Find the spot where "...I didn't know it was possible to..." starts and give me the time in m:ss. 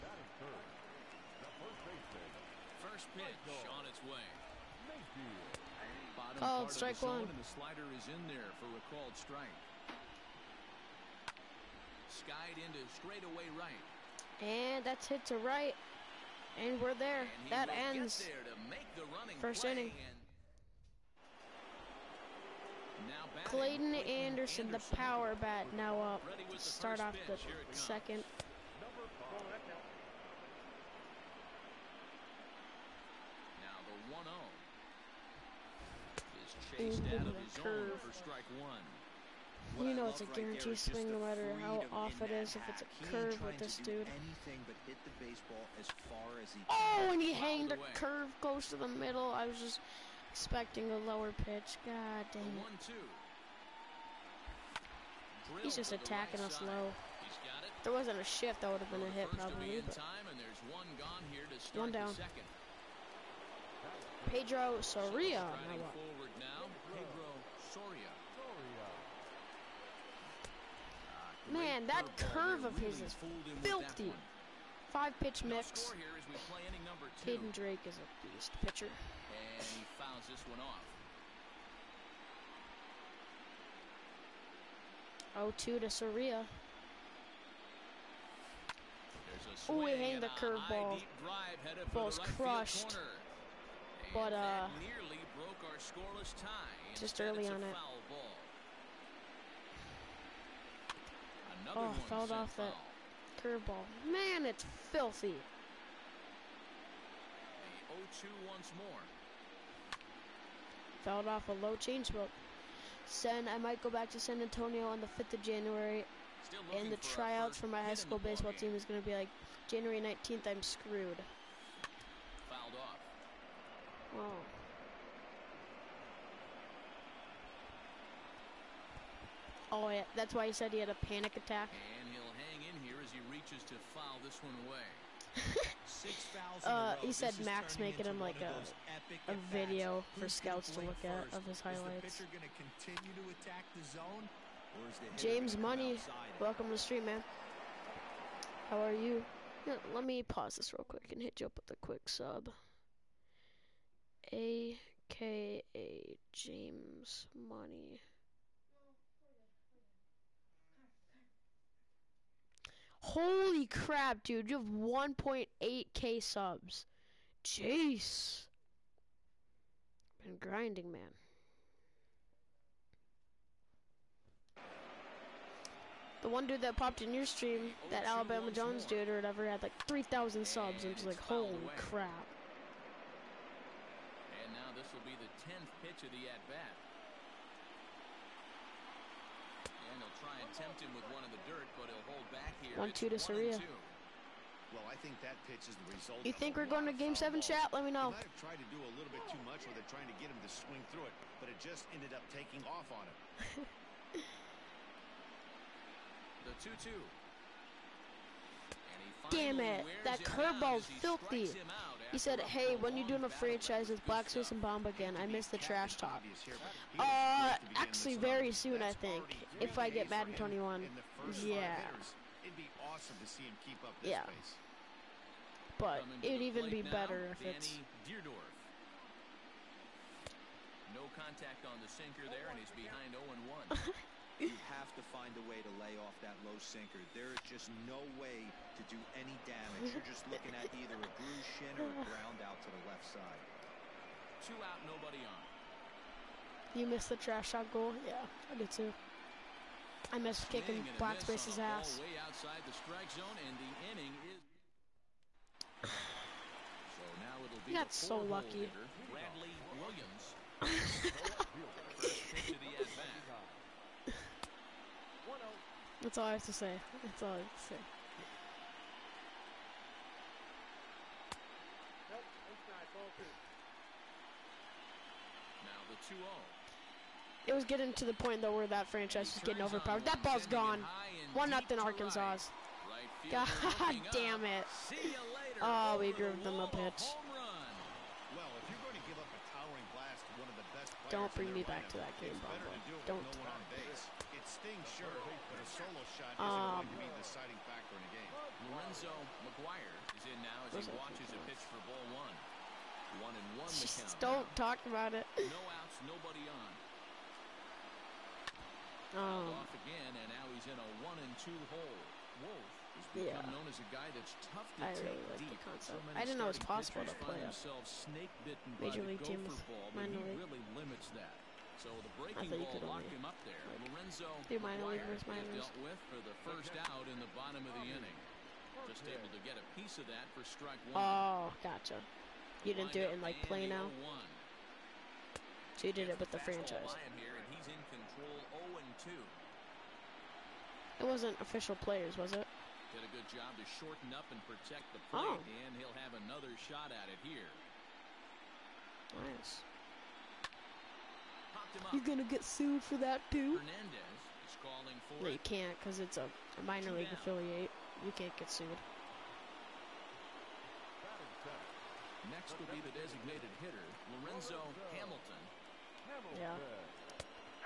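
5:16.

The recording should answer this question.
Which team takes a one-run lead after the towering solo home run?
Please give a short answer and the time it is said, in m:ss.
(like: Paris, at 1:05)
Arkansas, at 4:41.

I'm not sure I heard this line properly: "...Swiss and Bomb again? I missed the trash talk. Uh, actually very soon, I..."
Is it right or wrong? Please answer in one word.
right.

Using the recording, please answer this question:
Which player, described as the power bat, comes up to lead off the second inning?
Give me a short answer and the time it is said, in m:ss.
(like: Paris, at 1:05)
Clayton Anderson, at 0:23.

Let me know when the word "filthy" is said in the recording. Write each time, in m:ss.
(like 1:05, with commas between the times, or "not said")
1:13, 1:44, 3:30.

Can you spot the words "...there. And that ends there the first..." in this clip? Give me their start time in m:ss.
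0:16.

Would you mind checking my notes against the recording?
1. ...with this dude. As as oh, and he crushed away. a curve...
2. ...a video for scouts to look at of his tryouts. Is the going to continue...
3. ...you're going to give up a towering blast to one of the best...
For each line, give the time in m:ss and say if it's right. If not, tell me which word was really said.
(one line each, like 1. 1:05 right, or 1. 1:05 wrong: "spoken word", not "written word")
1. 0:43 wrong: "hanged", not "crushed"
2. 2:19 wrong: "highlights", not "tryouts"
3. 4:48 right.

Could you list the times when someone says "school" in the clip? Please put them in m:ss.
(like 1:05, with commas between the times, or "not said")
1:57.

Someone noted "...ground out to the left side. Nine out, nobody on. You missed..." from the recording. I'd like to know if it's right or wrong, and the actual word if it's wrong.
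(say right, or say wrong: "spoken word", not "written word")
wrong: "Two", not "Nine".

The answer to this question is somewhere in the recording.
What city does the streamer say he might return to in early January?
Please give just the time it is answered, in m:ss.
1:54.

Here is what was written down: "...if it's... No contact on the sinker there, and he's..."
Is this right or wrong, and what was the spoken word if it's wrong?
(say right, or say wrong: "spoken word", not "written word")
right.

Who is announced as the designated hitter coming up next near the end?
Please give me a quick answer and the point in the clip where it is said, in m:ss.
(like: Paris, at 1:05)
Lorenzo Hamilton, at 6:04.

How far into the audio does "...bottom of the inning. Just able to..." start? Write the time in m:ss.
5:27.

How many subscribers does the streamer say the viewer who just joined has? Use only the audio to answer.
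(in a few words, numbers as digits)
1.8k.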